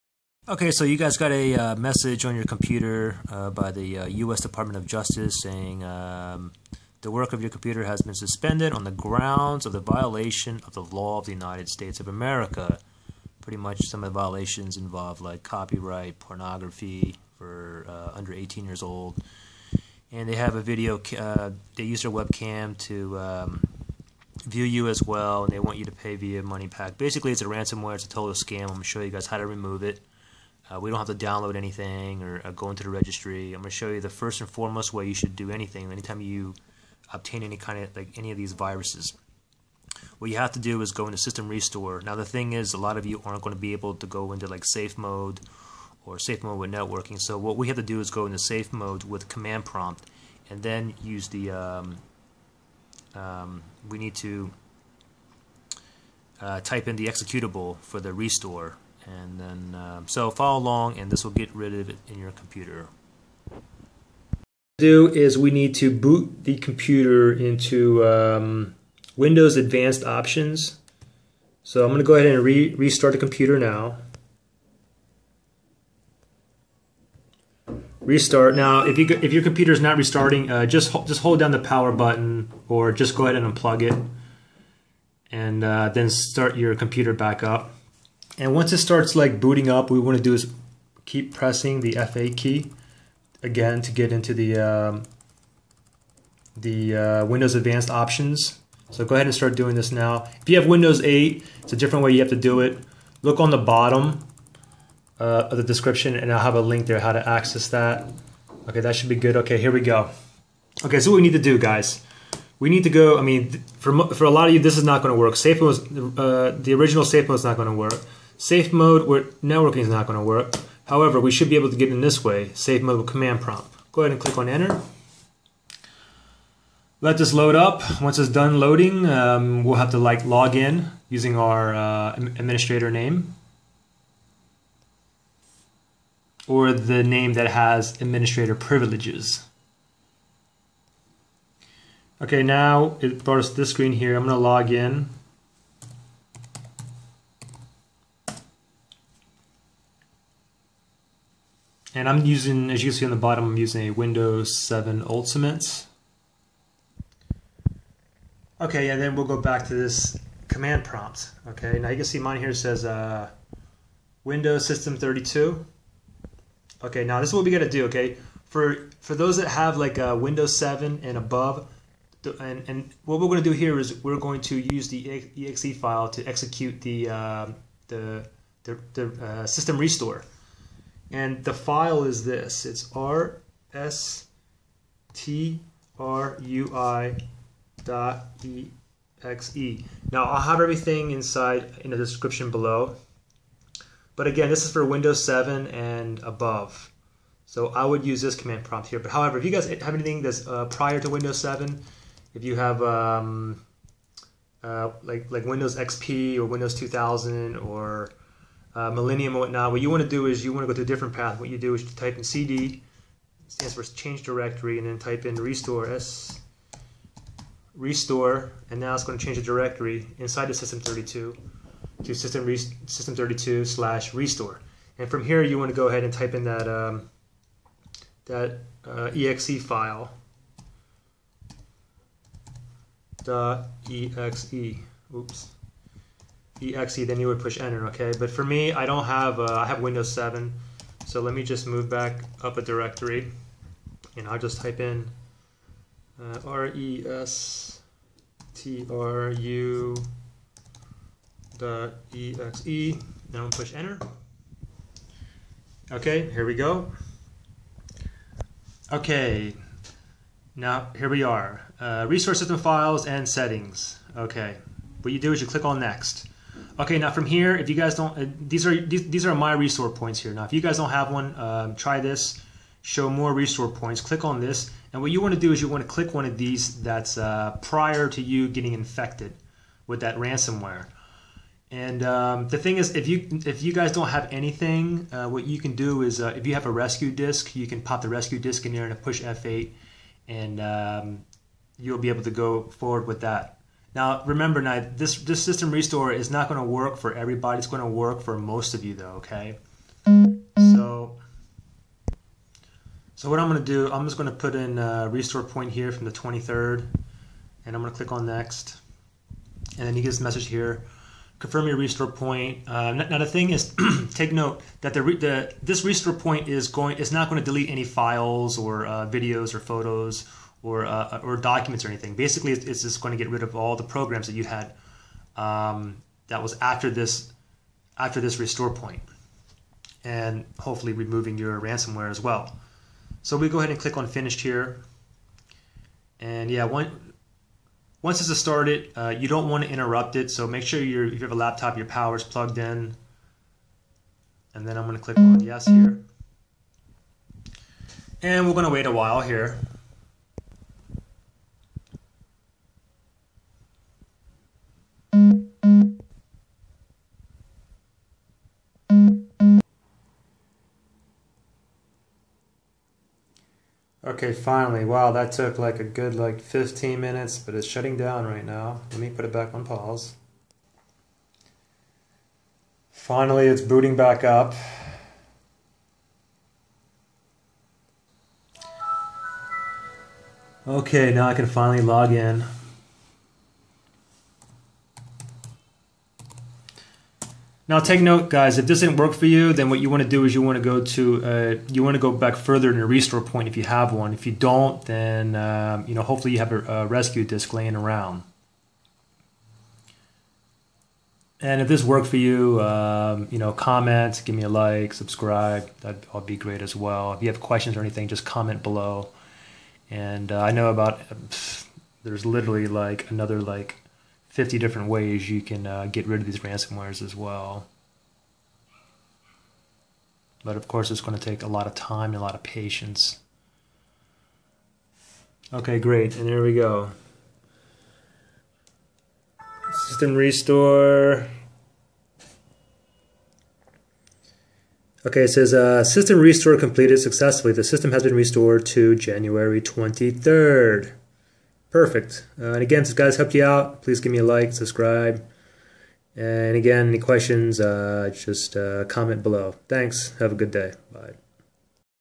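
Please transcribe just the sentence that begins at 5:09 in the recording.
And then you get this message here, confirm your restore point.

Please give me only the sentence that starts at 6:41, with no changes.
And if this worked for you, um, you know, comment, give me a like, subscribe.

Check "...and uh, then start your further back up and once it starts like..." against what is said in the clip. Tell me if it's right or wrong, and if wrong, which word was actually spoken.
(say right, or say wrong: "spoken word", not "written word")
wrong: "computer", not "further".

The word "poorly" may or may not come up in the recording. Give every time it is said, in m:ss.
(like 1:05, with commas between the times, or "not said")
not said.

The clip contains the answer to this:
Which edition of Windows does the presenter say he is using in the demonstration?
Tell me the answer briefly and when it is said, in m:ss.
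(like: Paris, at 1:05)
Windows 7 Ultimate, at 2:33.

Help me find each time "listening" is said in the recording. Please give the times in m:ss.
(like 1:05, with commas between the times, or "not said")
not said.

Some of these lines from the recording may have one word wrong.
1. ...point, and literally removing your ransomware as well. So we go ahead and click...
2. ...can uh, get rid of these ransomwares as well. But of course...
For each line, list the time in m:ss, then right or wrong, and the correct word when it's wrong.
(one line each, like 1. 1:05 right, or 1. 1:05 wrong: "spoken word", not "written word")
1. 5:28 wrong: "hopefully", not "literally"
2. 6:55 right.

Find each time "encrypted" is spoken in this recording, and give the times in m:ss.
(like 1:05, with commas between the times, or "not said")
not said.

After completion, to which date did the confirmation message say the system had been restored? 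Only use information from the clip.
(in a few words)
January 23rd.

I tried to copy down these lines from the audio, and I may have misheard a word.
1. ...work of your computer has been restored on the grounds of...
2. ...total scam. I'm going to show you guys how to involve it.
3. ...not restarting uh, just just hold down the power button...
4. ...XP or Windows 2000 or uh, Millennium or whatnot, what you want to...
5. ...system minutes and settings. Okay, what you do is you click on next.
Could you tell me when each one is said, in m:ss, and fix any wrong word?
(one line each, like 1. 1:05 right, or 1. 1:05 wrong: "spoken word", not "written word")
1. 0:07 wrong: "suspended", not "restored"
2. 0:28 wrong: "remove", not "involve"
3. 1:19 right
4. 3:25 right
5. 4:22 wrong: "files", not "minutes".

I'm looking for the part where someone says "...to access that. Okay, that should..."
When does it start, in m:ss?
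1:47.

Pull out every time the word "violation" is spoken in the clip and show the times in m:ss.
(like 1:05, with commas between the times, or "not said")
0:09, 0:14.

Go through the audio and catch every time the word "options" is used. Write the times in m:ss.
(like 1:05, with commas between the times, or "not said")
1:10, 1:37.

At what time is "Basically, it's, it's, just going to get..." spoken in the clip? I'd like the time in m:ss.
5:22.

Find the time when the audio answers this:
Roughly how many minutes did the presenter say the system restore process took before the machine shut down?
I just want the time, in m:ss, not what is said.
6:06.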